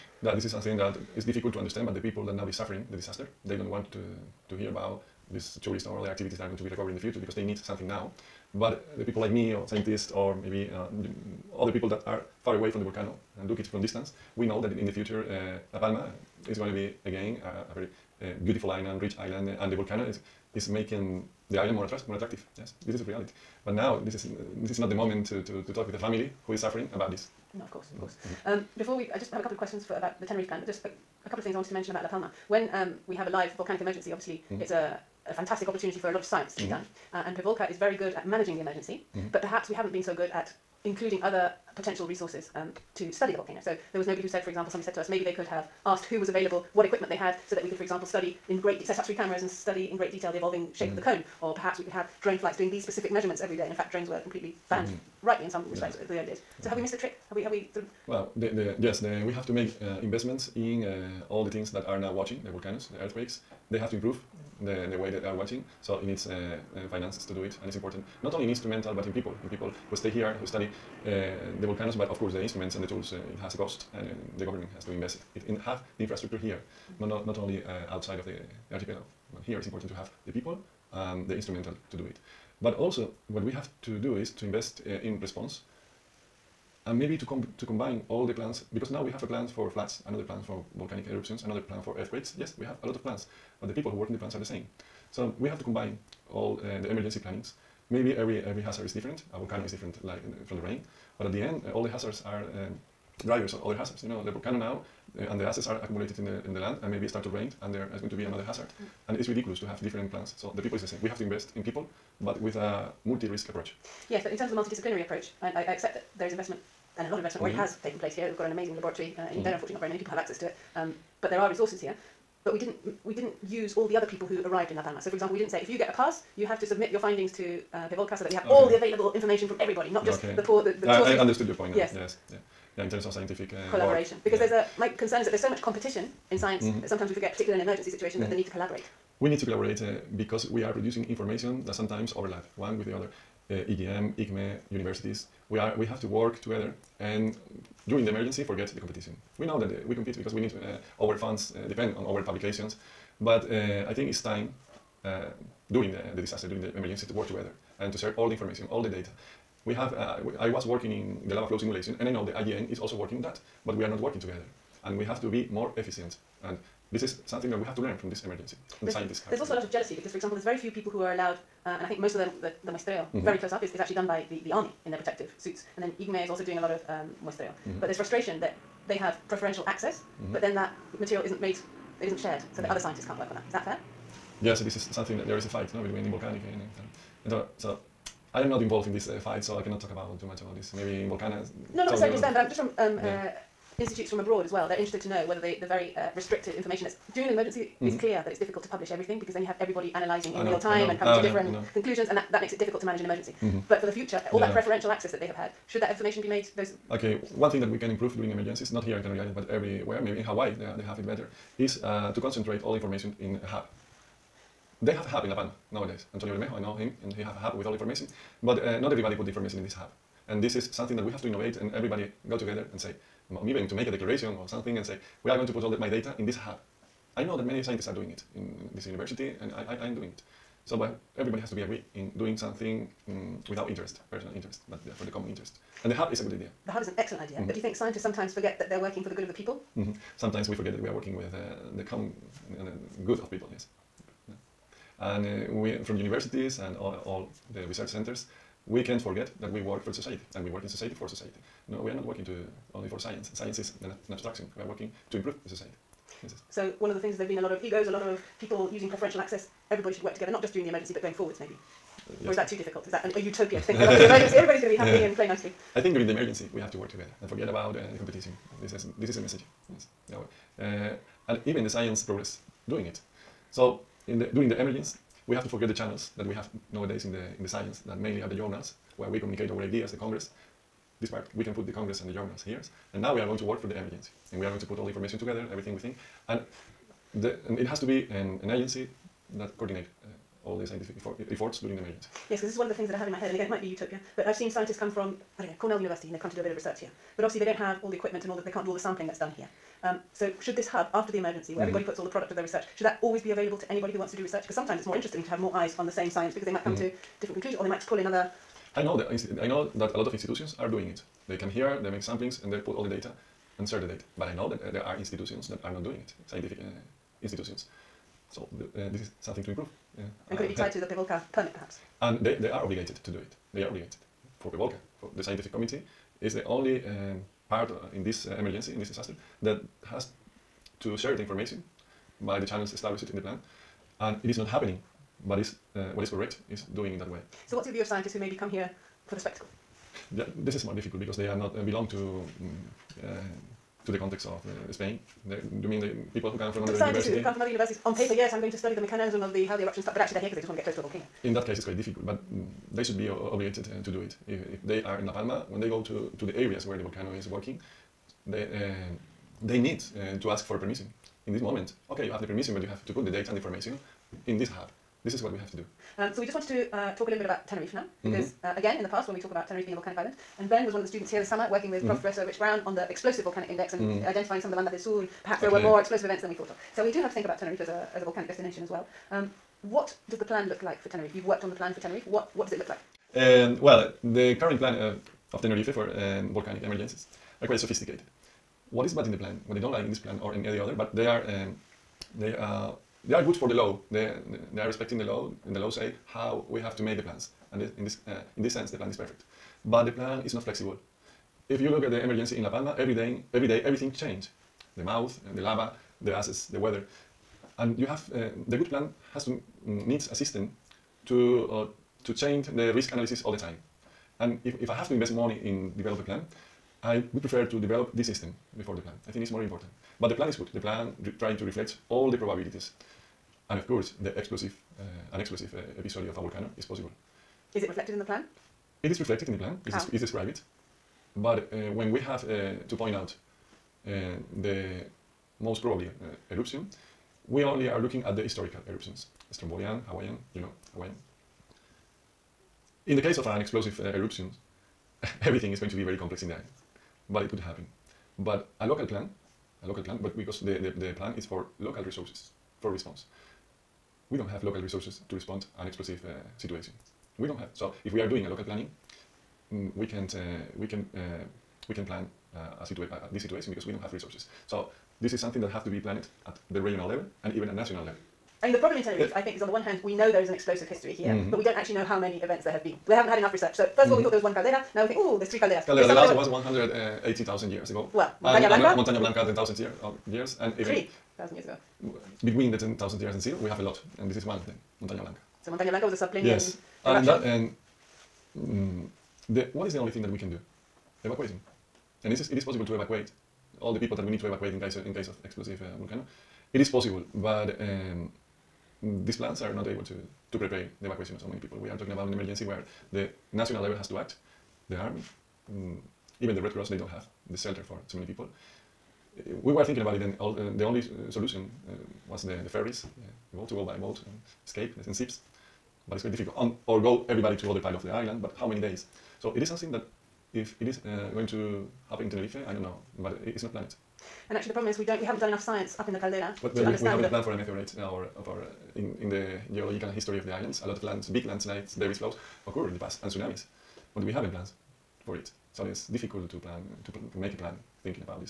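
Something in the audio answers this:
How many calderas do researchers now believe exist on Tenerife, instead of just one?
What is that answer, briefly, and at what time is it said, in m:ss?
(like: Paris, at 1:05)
3, at 7:55.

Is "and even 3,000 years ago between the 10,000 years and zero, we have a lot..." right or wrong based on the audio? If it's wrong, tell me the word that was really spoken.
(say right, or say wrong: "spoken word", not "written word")
right.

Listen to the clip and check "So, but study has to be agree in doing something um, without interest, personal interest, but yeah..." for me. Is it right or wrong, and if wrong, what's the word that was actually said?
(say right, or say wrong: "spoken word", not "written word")
wrong: "everybody", not "study".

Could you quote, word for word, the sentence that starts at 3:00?
but then that material isn't made, it isn't shared, so yeah.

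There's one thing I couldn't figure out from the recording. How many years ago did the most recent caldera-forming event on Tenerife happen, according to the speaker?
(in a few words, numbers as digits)
180,000 years.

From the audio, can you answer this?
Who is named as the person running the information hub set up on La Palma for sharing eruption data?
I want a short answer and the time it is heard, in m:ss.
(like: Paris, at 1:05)
Antonio Bermejo, at 3:36.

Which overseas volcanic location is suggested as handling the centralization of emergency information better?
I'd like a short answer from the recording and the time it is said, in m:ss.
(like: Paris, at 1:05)
Hawaii, at 3:30.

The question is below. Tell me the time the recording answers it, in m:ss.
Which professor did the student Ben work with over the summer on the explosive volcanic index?
6:12.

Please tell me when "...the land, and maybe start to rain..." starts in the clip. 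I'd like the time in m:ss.
1:46.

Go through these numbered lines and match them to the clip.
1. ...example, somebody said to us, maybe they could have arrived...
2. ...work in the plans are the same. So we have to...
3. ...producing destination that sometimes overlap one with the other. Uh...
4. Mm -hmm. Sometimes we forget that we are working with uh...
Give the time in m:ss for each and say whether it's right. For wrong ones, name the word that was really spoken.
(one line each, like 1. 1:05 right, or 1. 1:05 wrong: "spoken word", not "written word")
1. 0:44 wrong: "asked", not "arrived"
2. 1:33 right
3. 2:20 wrong: "information", not "destination"
4. 3:59 right.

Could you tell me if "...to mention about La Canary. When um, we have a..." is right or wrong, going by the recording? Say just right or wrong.
wrong.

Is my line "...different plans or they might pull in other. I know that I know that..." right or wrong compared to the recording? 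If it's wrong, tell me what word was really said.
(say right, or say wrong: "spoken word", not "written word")
wrong: "conclusions", not "plans".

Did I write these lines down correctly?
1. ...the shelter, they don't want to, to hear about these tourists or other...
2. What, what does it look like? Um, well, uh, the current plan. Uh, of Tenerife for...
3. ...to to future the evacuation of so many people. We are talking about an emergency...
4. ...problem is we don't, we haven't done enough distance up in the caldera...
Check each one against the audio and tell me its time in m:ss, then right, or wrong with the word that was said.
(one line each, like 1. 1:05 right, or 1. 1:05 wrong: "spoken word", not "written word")
1. 0:02 wrong: "disaster", not "shelter"
2. 6:22 right
3. 8:19 wrong: "prepare", not "future"
4. 8:44 wrong: "science", not "distance".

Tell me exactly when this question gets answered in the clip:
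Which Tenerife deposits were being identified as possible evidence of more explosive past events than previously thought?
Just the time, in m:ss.
6:14.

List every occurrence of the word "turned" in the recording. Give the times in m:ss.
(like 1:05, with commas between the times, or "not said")
not said.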